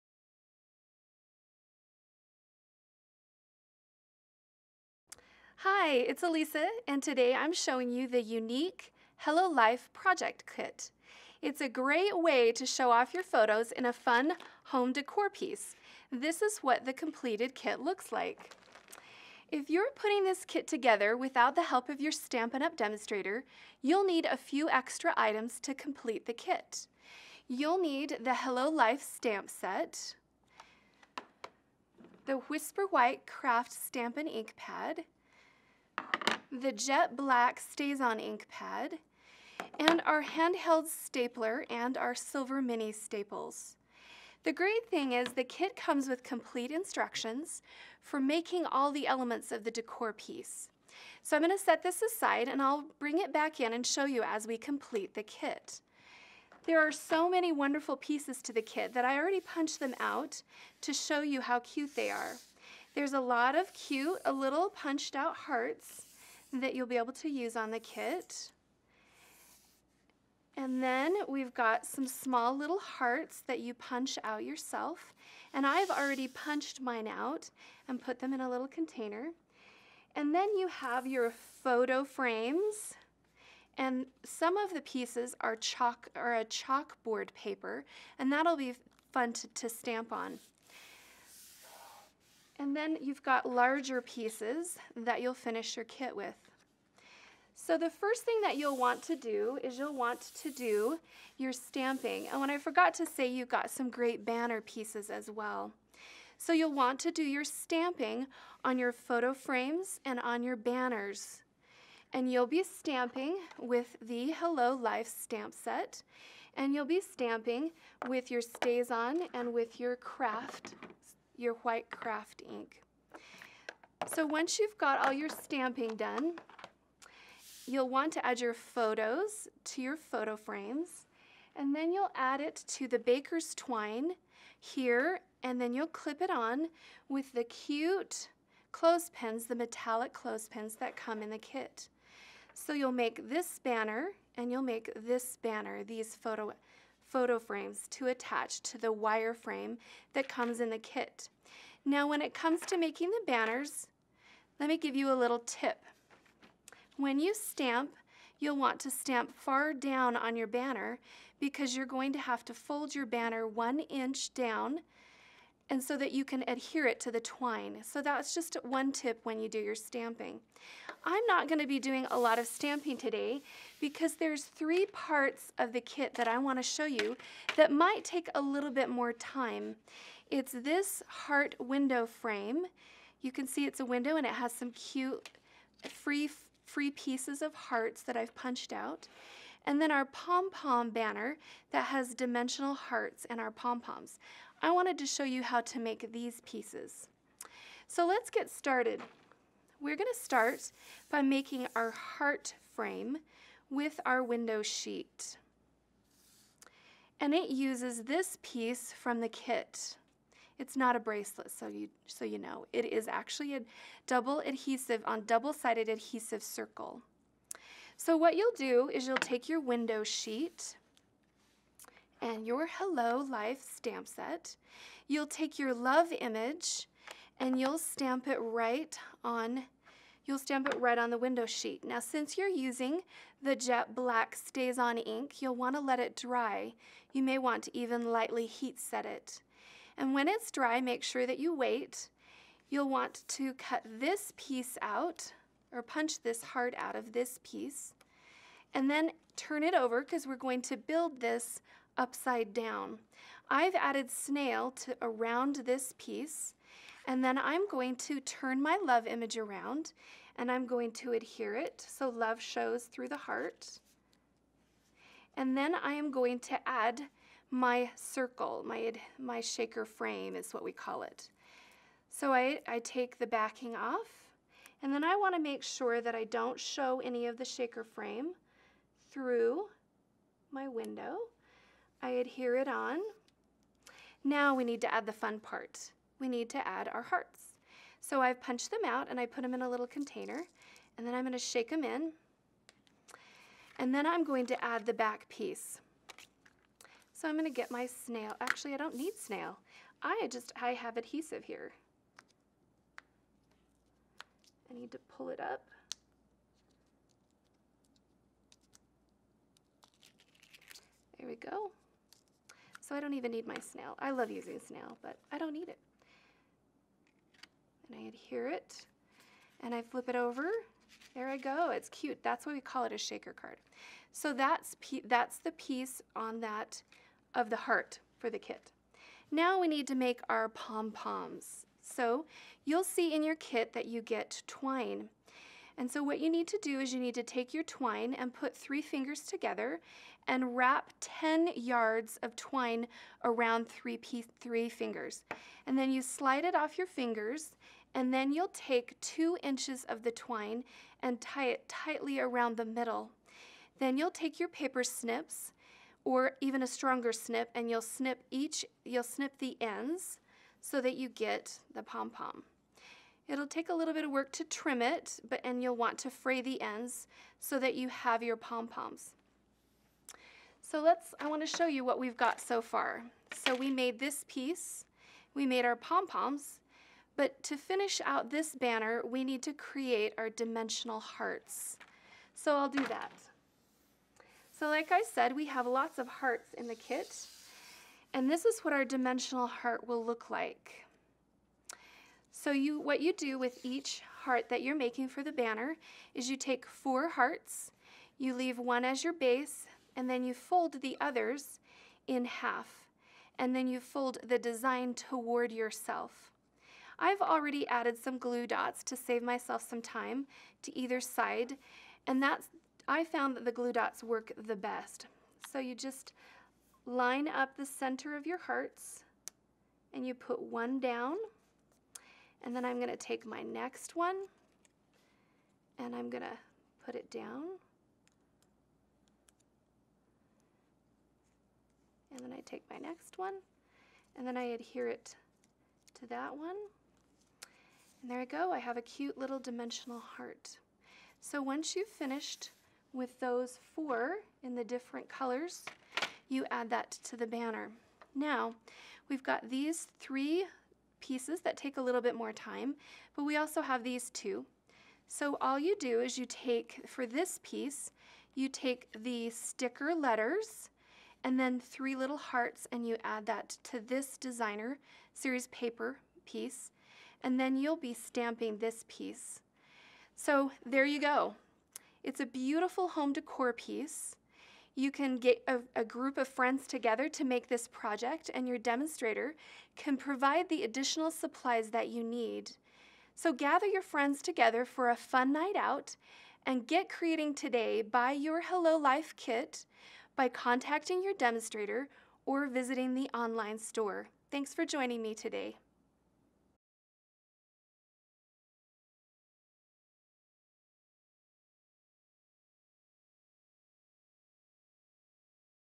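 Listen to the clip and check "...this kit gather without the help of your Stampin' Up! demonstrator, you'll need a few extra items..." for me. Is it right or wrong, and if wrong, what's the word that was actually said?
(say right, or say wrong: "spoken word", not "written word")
wrong: "together", not "gather".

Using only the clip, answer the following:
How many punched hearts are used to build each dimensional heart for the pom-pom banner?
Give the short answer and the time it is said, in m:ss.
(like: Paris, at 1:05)
4, at 6:36.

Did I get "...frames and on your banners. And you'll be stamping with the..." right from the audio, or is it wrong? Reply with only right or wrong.
right.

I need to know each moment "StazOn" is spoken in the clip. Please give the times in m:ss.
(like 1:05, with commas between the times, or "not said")
0:37, 1:58, 3:54.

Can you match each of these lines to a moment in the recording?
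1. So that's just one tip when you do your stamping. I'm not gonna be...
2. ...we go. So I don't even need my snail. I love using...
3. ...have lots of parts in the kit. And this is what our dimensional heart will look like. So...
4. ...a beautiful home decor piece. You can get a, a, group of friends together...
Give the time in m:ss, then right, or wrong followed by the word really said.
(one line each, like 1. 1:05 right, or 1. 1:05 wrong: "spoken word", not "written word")
1. 2:47 right
2. 5:11 right
3. 6:25 wrong: "hearts", not "parts"
4. 7:52 right.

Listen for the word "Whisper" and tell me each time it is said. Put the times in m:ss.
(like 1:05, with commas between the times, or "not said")
0:32.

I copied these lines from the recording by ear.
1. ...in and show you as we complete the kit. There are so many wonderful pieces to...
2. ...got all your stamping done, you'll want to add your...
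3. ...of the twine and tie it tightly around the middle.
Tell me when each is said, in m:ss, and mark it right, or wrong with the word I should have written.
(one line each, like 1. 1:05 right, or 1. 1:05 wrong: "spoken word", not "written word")
1. 0:53 right
2. 2:04 right
3. 5:49 right.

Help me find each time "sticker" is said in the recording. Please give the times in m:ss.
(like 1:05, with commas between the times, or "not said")
7:39.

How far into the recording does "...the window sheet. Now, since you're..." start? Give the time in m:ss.
3:51.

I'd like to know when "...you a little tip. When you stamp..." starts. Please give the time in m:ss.
2:34.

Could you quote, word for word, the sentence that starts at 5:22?
That's why we call it a shaker card.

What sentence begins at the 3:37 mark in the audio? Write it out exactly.
So what you'll do is you'll take your window sheet and your Hello Life stamp set.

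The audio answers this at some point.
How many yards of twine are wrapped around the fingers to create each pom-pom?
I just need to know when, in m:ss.
5:41.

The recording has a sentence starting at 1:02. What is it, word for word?
There's a lot of cute, a little punched out hearts that you'll be able to use on the kit.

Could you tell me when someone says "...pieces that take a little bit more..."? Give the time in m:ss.
7:30.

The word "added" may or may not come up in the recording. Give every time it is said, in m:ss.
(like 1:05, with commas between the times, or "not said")
4:13, 6:47.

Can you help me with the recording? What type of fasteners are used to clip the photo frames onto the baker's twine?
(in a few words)
Metallic clothespins.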